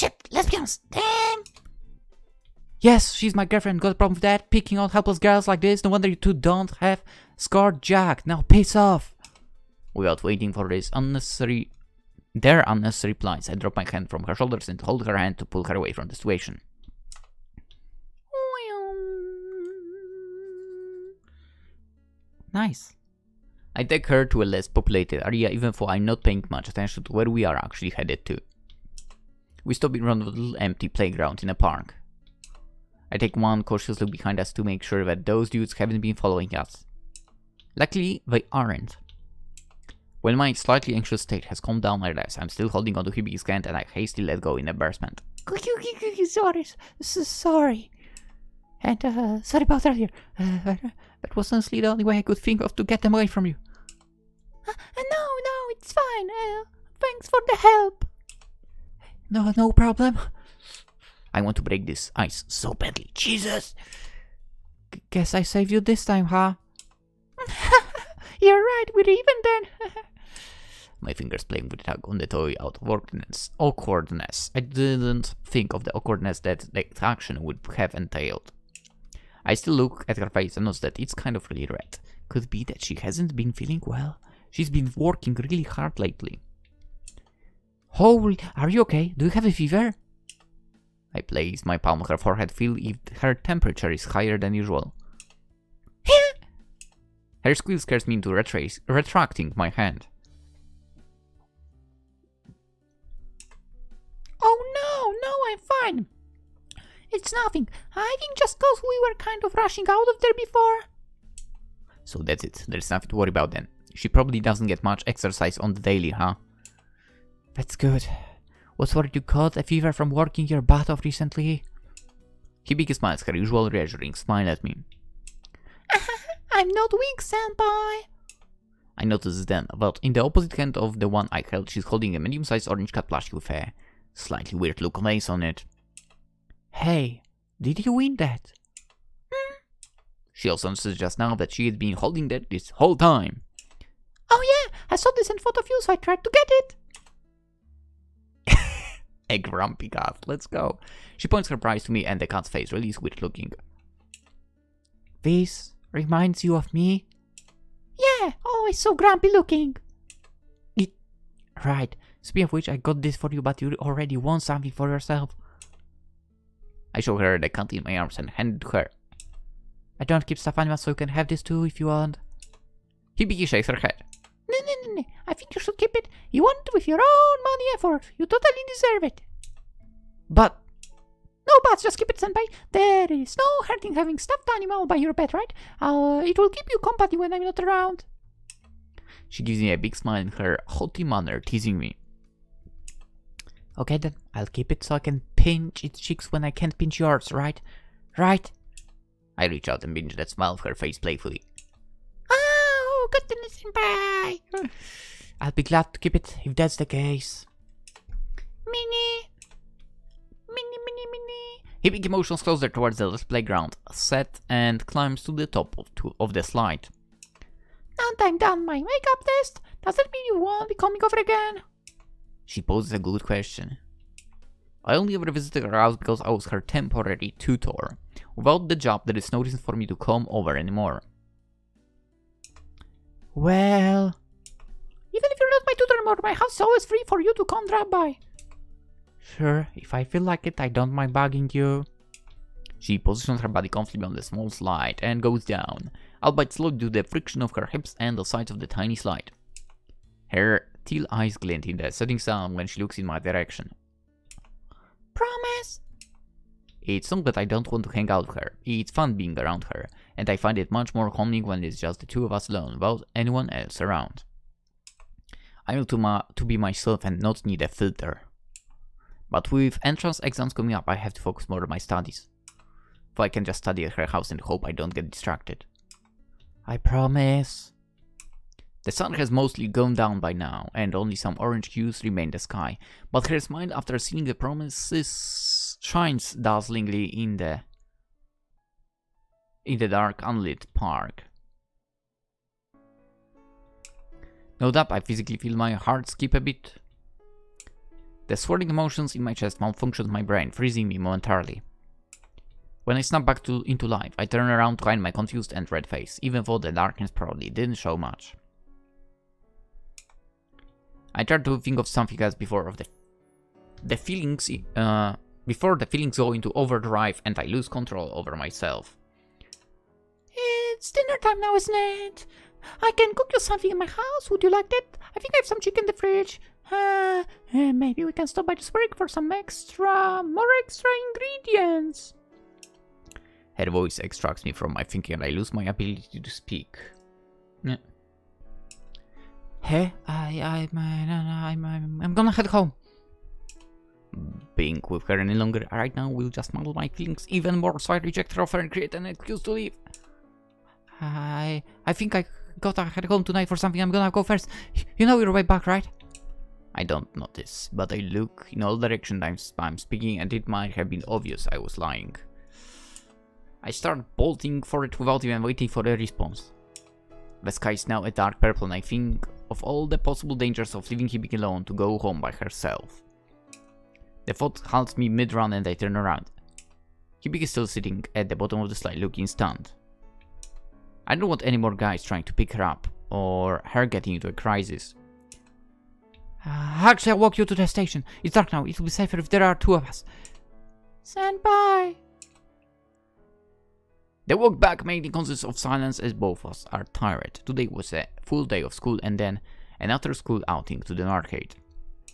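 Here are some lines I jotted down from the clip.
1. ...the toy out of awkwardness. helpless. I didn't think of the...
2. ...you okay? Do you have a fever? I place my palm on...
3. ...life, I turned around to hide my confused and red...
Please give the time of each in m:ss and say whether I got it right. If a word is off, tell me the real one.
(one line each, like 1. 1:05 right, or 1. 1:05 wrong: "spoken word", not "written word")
1. 1:12 wrong: "awkwardness", not "helpless"
2. 1:28 right
3. 5:03 right.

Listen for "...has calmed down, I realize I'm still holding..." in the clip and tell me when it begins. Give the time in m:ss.
0:41.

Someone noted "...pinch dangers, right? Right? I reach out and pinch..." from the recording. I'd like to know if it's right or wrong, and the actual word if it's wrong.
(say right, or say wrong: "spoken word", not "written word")
wrong: "yours", not "dangers".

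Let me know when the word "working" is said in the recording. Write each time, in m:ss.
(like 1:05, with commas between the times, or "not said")
1:24, 2:00.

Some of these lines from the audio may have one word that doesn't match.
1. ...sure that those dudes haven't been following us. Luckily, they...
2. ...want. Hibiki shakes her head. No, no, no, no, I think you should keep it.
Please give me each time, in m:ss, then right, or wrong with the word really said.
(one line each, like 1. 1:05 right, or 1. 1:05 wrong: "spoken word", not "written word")
1. 0:34 right
2. 2:51 right.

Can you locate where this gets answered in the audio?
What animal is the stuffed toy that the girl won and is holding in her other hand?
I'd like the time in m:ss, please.
2:12.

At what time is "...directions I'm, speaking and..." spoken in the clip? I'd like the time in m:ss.
5:58.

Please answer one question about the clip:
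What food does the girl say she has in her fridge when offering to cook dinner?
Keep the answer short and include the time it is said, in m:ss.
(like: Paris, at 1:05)
Chicken, at 5:25.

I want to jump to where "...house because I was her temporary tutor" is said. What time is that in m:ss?
3:45.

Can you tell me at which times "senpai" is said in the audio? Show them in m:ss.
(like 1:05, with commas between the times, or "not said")
2:07, 3:02.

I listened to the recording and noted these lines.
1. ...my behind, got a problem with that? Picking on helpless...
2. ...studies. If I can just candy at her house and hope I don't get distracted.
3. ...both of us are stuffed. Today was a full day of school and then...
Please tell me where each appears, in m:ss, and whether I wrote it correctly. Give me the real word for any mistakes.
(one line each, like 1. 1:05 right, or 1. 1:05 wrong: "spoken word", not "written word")
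1. 0:03 wrong: "girlfriend", not "behind"
2. 4:31 wrong: "study", not "candy"
3. 6:36 wrong: "tired", not "stuffed".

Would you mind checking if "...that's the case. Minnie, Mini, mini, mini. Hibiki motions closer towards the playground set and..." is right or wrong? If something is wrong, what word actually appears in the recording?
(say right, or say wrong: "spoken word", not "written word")
right.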